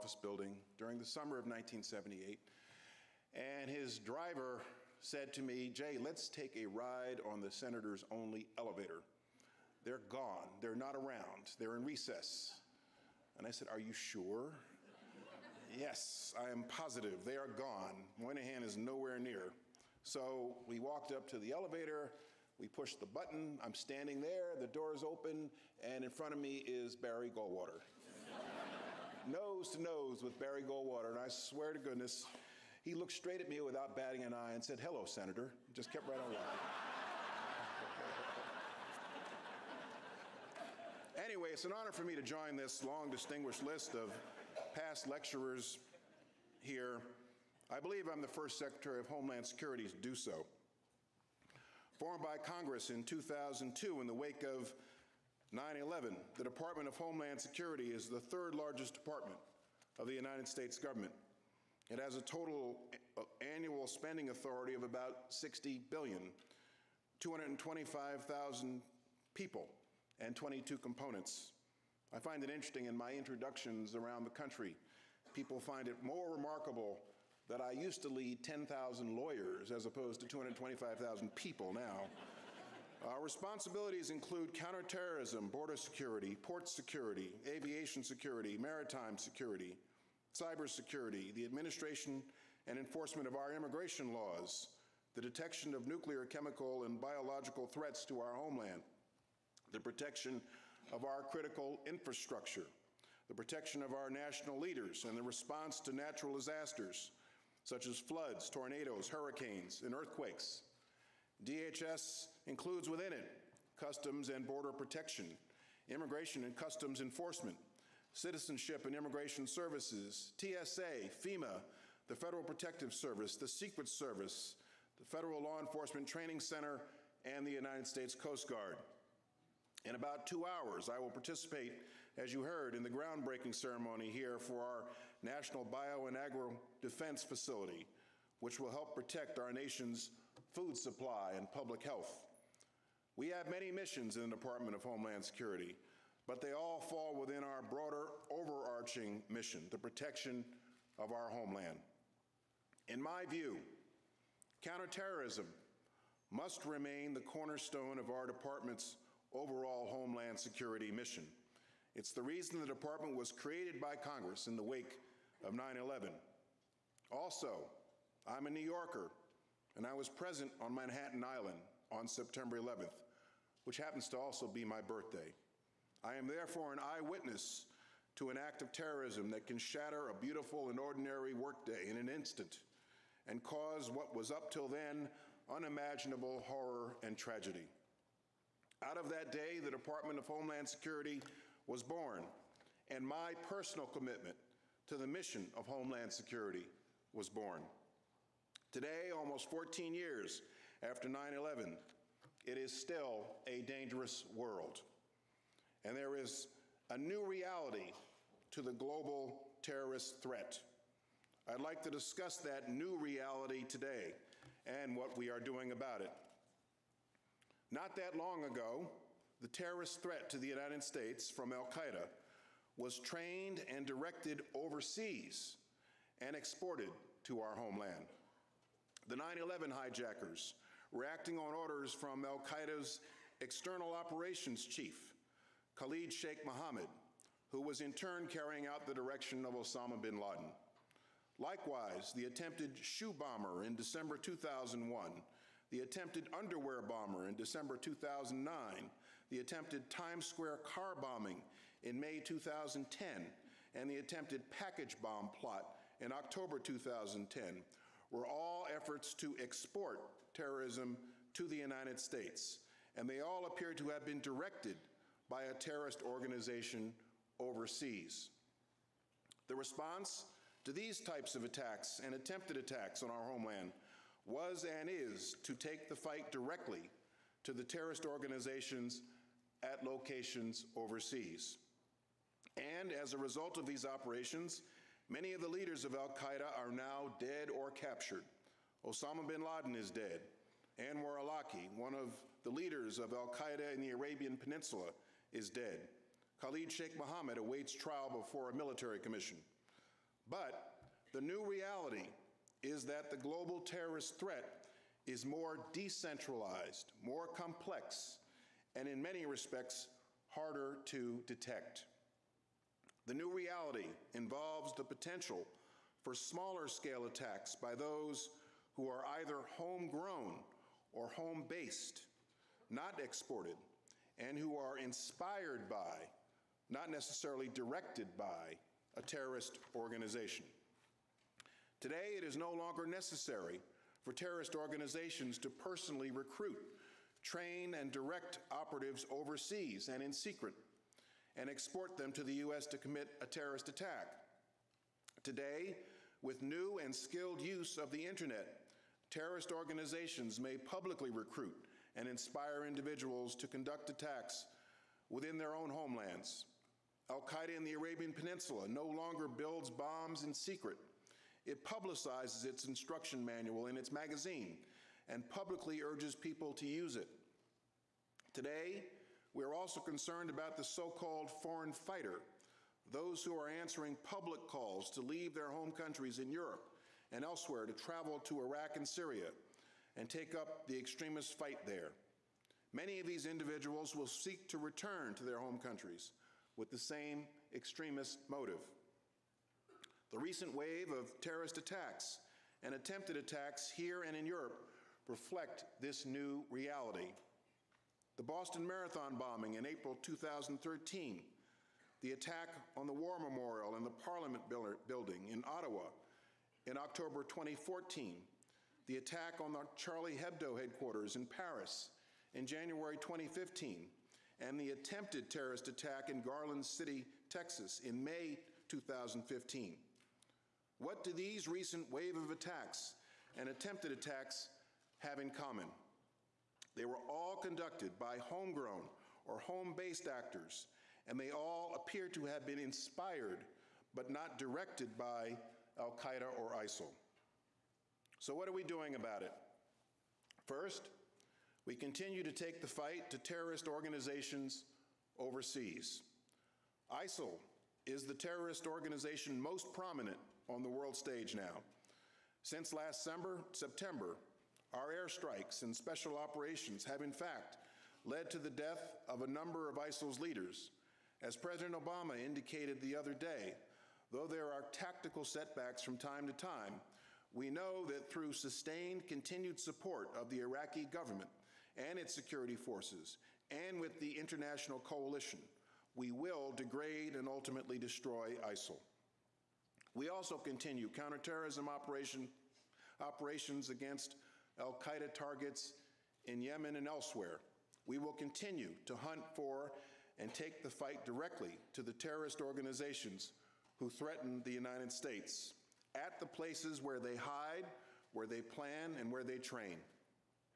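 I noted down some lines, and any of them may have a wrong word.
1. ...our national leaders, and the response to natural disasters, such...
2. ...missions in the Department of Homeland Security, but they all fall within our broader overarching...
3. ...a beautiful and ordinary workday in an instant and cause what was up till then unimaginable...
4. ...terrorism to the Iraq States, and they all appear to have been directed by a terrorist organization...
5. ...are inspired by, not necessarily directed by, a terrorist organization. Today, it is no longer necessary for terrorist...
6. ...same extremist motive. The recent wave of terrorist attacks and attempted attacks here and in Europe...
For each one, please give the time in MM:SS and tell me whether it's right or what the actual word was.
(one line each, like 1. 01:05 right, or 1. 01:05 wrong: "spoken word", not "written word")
1. 01:43 right
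2. 02:23 right
3. 03:00 right
4. 04:20 wrong: "United", not "Iraq"
5. 05:24 right
6. 06:26 right.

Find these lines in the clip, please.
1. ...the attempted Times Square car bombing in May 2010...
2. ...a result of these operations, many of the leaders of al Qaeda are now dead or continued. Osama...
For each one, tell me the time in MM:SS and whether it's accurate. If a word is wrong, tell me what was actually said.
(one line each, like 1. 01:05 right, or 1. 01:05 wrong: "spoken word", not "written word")
1. 04:09 right
2. 04:43 wrong: "captured", not "continued".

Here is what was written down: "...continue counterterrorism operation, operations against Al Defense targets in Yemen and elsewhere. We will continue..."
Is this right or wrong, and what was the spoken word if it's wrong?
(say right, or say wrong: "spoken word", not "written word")
wrong: "Qaeda", not "Defense".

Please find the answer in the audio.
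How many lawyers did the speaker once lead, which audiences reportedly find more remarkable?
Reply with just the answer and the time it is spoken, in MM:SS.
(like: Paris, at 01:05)
10,000, at 01:18.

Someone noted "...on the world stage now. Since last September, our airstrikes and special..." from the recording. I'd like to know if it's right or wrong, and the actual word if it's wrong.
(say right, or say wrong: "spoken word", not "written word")
right.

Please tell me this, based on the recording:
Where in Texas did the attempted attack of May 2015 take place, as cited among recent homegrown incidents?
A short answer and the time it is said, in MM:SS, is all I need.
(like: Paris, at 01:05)
Garland City, at 06:56.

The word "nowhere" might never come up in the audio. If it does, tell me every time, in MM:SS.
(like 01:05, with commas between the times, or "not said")
00:18.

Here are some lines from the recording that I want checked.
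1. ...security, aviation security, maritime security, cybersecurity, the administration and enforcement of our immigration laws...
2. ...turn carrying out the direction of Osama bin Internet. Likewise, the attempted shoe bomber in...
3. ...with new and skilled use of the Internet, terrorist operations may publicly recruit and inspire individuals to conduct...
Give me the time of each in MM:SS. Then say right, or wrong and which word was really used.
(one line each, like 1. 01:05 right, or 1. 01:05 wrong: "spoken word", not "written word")
1. 01:26 right
2. 03:57 wrong: "Laden", not "Internet"
3. 05:46 wrong: "organizations", not "operations".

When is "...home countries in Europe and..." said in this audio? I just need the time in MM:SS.
06:15.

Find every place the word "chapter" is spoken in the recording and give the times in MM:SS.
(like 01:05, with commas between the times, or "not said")
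not said.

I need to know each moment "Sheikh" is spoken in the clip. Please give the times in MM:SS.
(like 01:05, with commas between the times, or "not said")
03:56, 04:56.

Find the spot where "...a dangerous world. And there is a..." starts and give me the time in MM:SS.
03:23.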